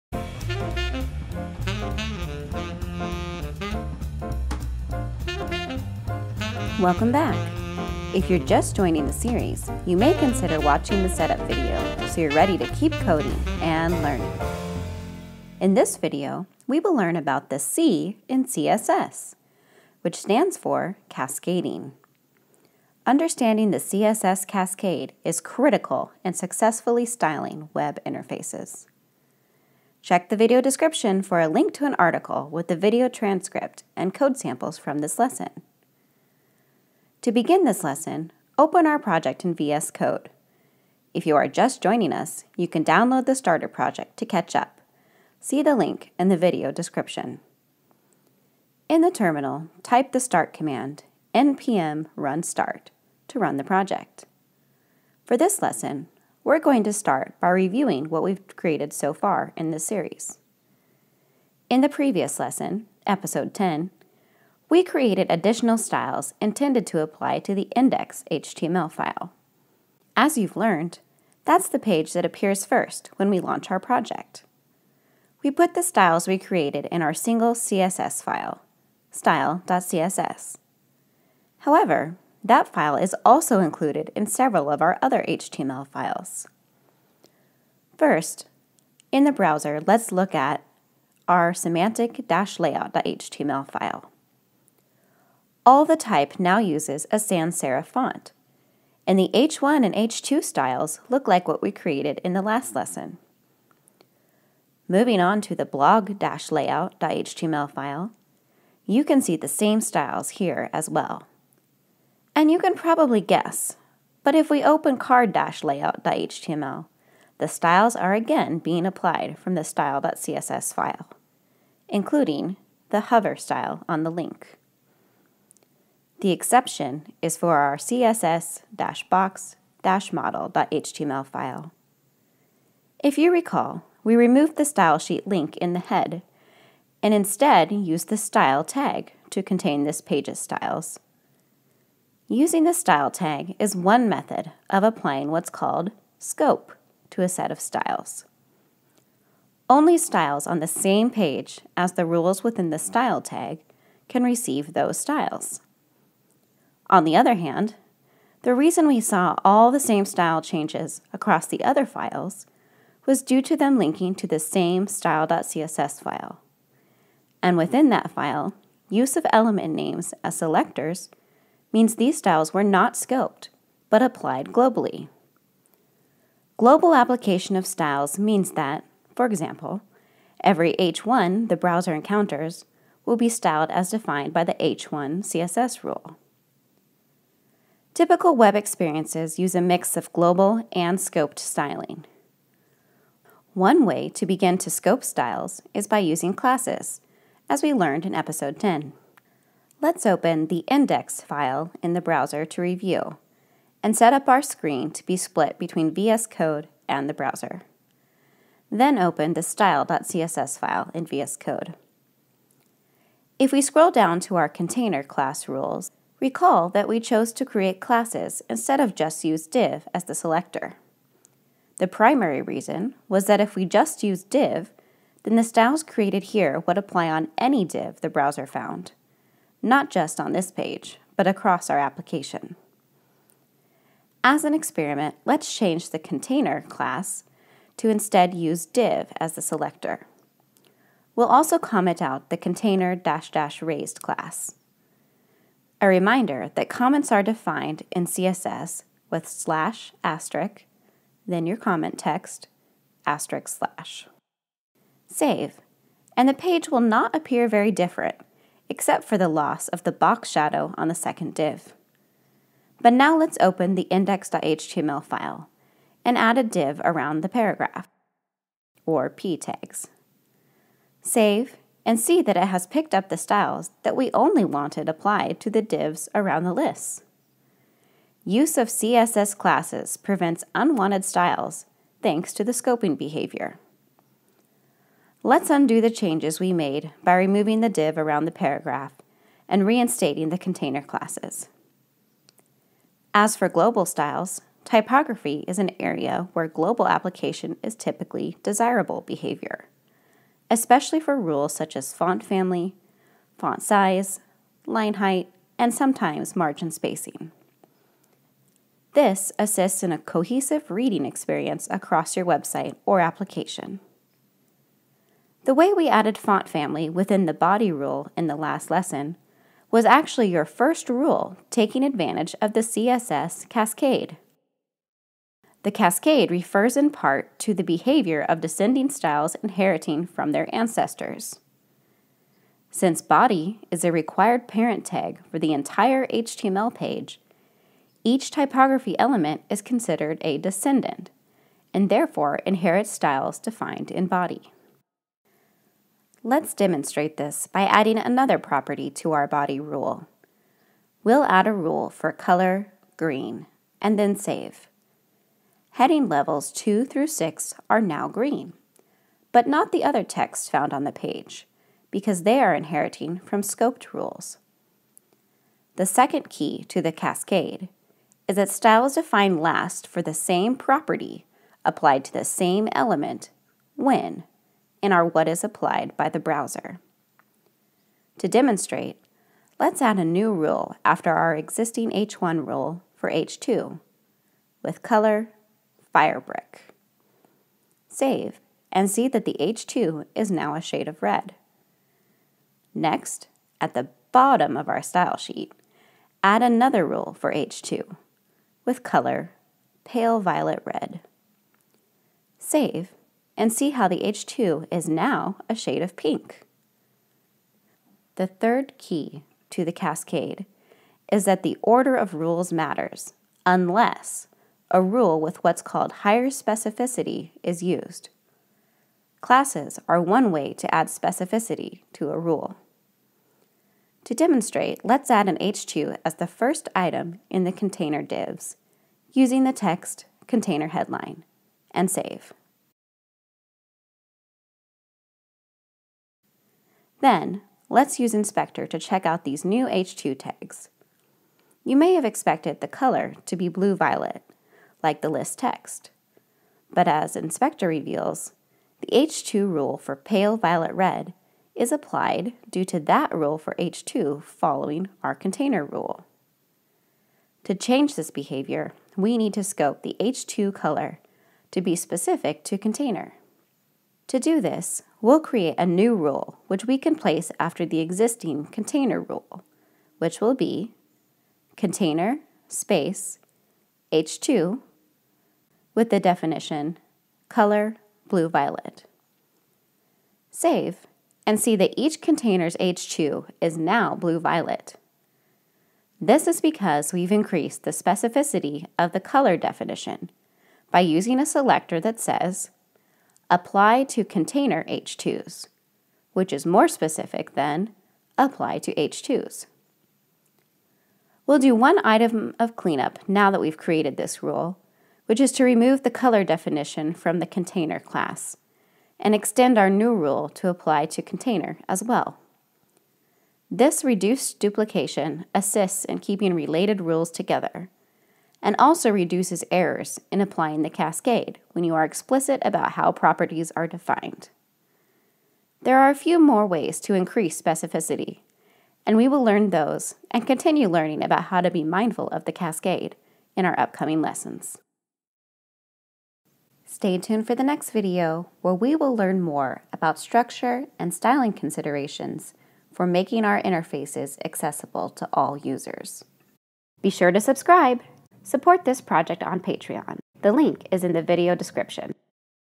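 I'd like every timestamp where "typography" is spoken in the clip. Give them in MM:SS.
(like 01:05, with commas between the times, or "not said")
04:54, 05:38.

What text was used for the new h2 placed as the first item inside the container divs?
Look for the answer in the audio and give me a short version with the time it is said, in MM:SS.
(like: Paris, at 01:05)
container headline, at 07:10.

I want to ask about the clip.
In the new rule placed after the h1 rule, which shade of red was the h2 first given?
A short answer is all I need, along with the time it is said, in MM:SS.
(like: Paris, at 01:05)
Firebrick, at 06:25.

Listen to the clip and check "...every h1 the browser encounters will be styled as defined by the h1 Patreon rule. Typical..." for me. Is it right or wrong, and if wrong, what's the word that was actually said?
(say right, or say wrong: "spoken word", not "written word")
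wrong: "CSS", not "Patreon".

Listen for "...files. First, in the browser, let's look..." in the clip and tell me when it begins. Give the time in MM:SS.
01:25.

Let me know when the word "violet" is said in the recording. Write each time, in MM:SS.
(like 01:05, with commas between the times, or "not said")
06:40, 07:23, 07:30, 07:58, 08:04.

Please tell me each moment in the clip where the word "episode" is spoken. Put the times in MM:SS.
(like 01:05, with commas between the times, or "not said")
01:03, 03:18.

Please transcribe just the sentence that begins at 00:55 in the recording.
For this lesson, we're going to start by reviewing what we've created so far in this series.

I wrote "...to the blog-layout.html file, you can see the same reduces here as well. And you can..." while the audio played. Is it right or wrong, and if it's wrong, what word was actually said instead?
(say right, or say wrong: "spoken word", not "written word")
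wrong: "styles", not "reduces".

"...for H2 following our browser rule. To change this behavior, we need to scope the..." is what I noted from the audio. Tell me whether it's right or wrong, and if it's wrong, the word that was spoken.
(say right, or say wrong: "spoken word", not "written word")
wrong: "container", not "browser".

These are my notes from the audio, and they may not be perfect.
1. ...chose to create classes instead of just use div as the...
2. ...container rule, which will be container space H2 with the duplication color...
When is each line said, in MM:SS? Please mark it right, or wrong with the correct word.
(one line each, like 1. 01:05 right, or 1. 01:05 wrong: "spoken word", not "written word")
1. 03:36 right
2. 07:48 wrong: "definition", not "duplication".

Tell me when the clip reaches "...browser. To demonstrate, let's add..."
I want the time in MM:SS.
06:16.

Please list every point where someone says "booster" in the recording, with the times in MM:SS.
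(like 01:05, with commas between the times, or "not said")
not said.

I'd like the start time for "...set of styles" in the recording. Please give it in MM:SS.
02:27.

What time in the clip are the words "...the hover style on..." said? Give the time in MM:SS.
02:02.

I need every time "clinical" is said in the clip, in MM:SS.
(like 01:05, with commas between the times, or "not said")
not said.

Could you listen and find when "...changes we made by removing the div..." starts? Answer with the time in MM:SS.
04:45.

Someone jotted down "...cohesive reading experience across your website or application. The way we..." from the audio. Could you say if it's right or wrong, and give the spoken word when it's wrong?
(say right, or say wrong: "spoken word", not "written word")
right.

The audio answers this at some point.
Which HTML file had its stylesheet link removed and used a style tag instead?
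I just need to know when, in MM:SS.
02:07.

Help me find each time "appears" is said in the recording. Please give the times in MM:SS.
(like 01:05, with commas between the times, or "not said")
01:12, 04:17.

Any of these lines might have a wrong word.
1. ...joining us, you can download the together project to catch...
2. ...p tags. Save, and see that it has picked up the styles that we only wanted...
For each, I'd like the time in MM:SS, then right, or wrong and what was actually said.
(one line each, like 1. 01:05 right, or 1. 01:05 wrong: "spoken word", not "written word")
1. 00:41 wrong: "starter", not "together"
2. 04:29 right.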